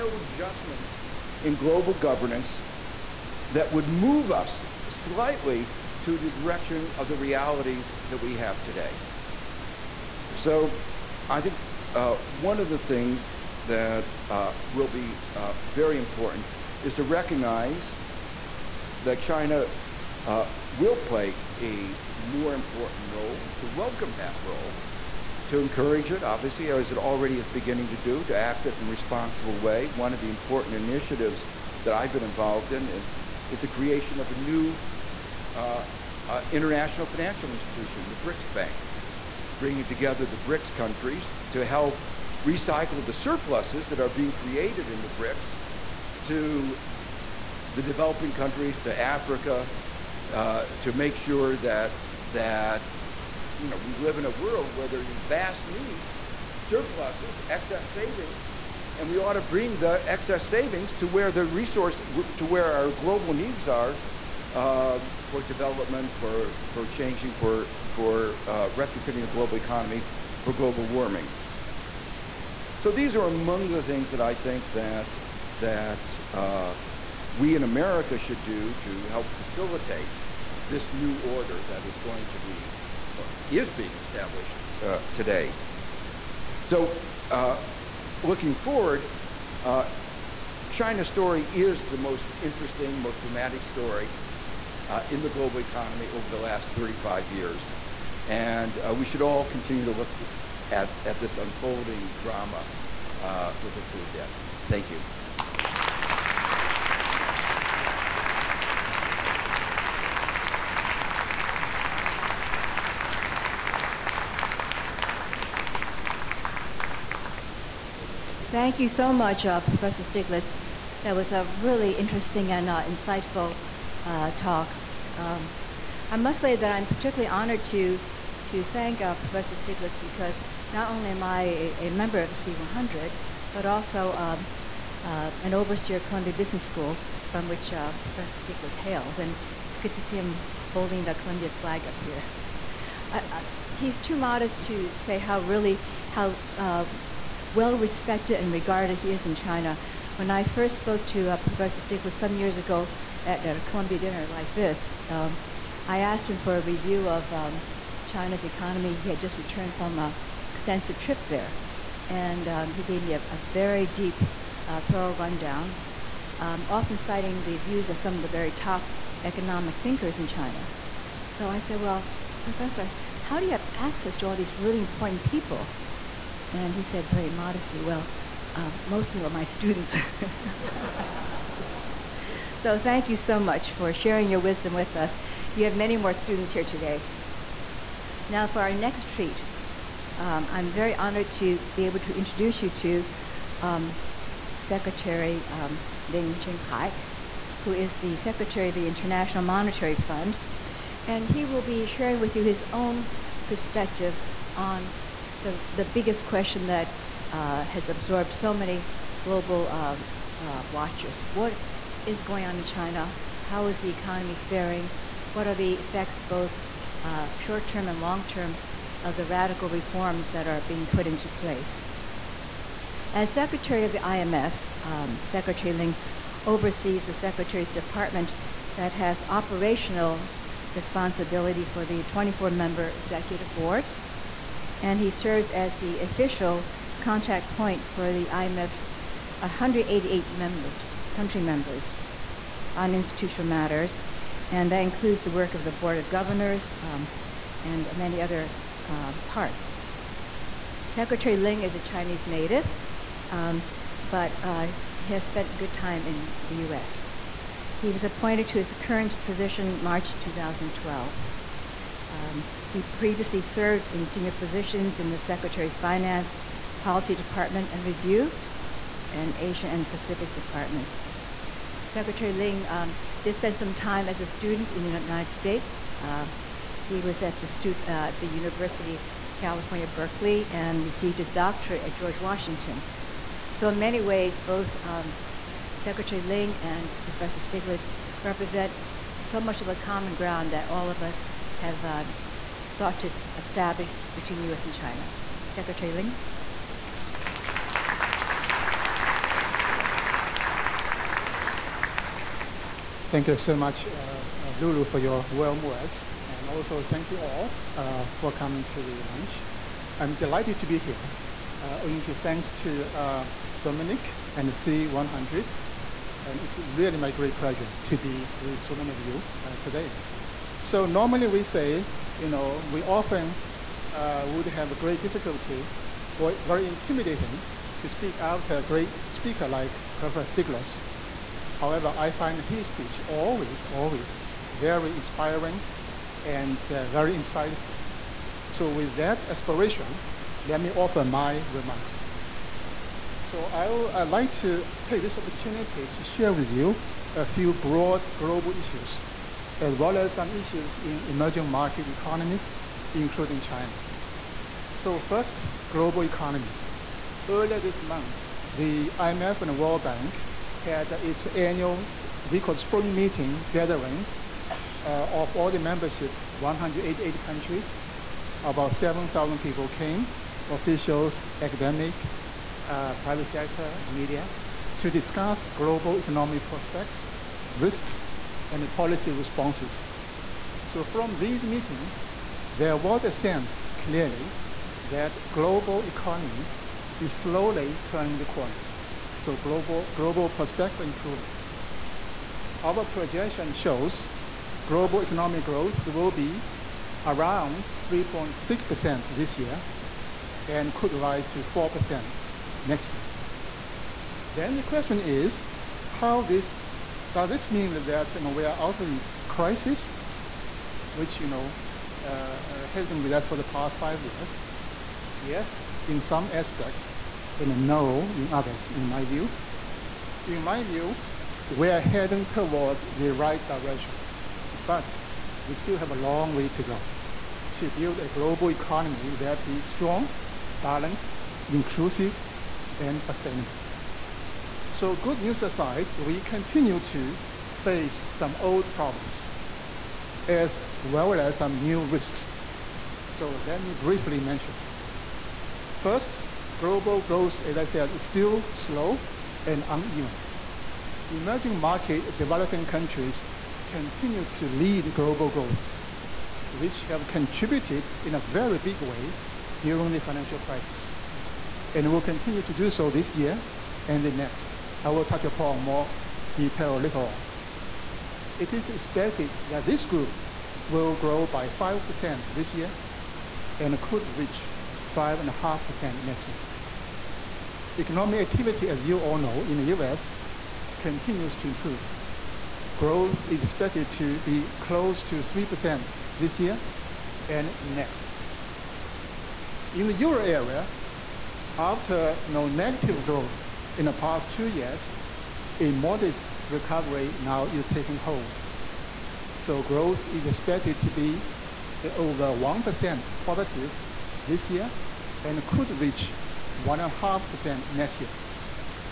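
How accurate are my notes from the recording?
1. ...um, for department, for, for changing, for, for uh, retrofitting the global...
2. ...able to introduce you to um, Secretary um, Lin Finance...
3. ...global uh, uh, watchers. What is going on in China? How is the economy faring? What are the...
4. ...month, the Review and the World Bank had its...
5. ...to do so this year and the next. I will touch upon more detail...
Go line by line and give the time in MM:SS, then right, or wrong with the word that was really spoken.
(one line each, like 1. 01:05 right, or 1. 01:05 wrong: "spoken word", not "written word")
1. 01:04 wrong: "development", not "department"
2. 03:11 wrong: "Jianhai", not "Finance"
3. 03:29 right
4. 05:57 wrong: "IMF", not "Review"
5. 07:42 right.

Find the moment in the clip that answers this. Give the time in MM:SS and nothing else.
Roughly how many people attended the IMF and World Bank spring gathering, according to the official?
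06:08.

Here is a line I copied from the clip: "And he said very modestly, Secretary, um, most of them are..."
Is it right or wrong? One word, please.
wrong.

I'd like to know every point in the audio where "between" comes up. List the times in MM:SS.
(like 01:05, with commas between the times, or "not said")
04:54.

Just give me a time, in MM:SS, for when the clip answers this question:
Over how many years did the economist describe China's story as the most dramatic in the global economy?
01:36.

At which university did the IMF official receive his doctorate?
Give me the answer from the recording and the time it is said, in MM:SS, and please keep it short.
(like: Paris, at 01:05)
George Washington, at 04:41.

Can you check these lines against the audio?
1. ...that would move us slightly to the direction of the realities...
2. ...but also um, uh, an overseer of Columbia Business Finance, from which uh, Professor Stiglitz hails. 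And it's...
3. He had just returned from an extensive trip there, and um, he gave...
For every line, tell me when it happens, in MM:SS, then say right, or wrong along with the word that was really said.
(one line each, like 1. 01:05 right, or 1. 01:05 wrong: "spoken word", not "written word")
1. 00:03 right
2. 02:13 wrong: "School", not "Finance"
3. 02:38 right.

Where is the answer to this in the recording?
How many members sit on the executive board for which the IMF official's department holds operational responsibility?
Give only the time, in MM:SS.
03:52.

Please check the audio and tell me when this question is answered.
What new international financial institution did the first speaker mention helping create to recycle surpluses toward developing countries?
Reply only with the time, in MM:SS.
00:38.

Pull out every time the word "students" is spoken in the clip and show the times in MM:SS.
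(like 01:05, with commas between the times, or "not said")
02:59, 03:06, 04:34.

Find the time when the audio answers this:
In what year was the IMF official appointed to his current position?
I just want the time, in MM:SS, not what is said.
04:19.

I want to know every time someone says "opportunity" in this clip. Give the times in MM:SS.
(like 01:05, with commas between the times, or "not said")
05:45.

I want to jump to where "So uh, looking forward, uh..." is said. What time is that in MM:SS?
01:26.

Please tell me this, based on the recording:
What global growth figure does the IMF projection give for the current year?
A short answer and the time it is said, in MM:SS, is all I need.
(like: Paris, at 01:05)
3.6%, at 06:37.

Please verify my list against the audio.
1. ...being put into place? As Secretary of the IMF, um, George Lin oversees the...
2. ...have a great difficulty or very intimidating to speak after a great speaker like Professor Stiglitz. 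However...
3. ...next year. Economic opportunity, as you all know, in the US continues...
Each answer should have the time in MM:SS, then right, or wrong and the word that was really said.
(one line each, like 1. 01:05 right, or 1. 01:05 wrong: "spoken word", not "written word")
1. 03:40 wrong: "Secretary", not "George"
2. 05:24 right
3. 07:56 wrong: "activity", not "opportunity".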